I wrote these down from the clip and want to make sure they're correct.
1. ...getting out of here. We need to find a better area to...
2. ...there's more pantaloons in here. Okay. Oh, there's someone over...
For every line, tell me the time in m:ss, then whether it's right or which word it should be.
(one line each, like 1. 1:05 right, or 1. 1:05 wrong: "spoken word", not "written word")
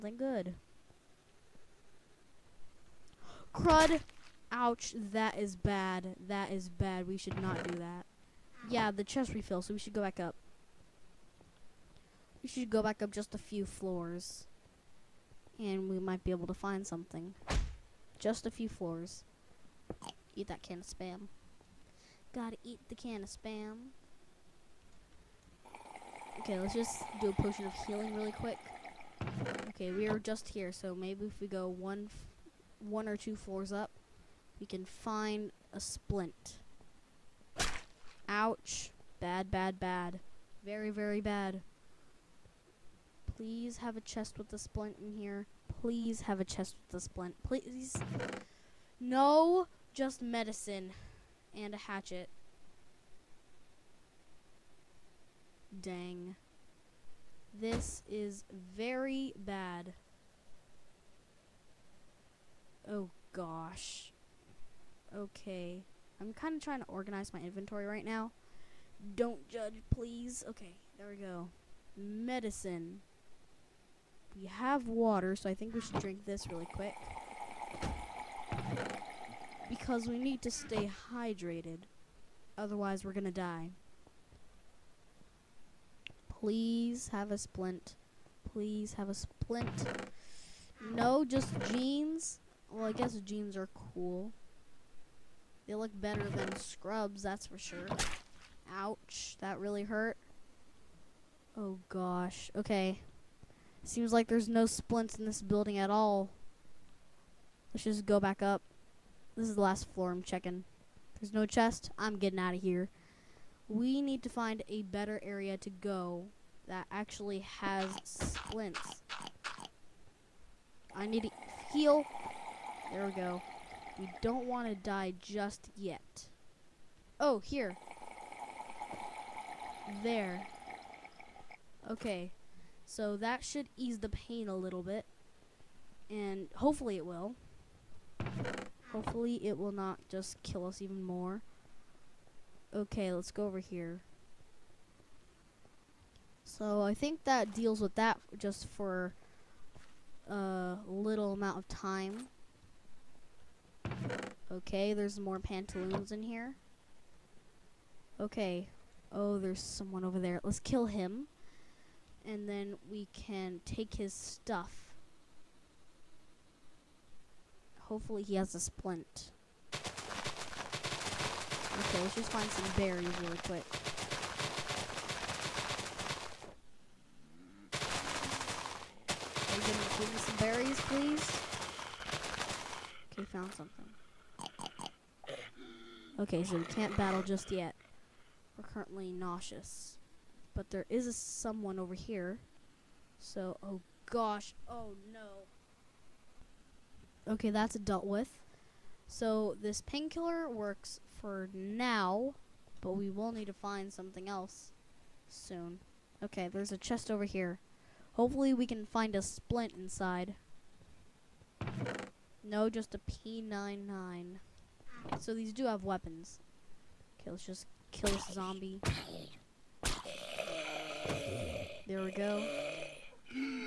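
1. 1:52 right
2. 2:34 right.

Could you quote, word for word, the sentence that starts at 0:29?
Okay, we are just here, so maybe if we go one, one or two floors up, we can find a splint.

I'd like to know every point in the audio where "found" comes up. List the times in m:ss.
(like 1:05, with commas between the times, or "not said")
3:03.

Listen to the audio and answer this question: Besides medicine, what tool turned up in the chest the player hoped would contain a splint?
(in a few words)
hatchet.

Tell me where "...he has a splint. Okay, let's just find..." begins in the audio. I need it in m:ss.
2:48.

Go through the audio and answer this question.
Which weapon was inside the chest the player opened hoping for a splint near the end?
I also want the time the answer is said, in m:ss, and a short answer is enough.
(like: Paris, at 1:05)
P99, at 3:32.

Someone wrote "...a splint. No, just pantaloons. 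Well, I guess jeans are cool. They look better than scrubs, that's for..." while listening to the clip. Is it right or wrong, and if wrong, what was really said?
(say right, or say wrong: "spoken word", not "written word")
wrong: "jeans", not "pantaloons".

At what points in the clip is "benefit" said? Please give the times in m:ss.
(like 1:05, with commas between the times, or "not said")
not said.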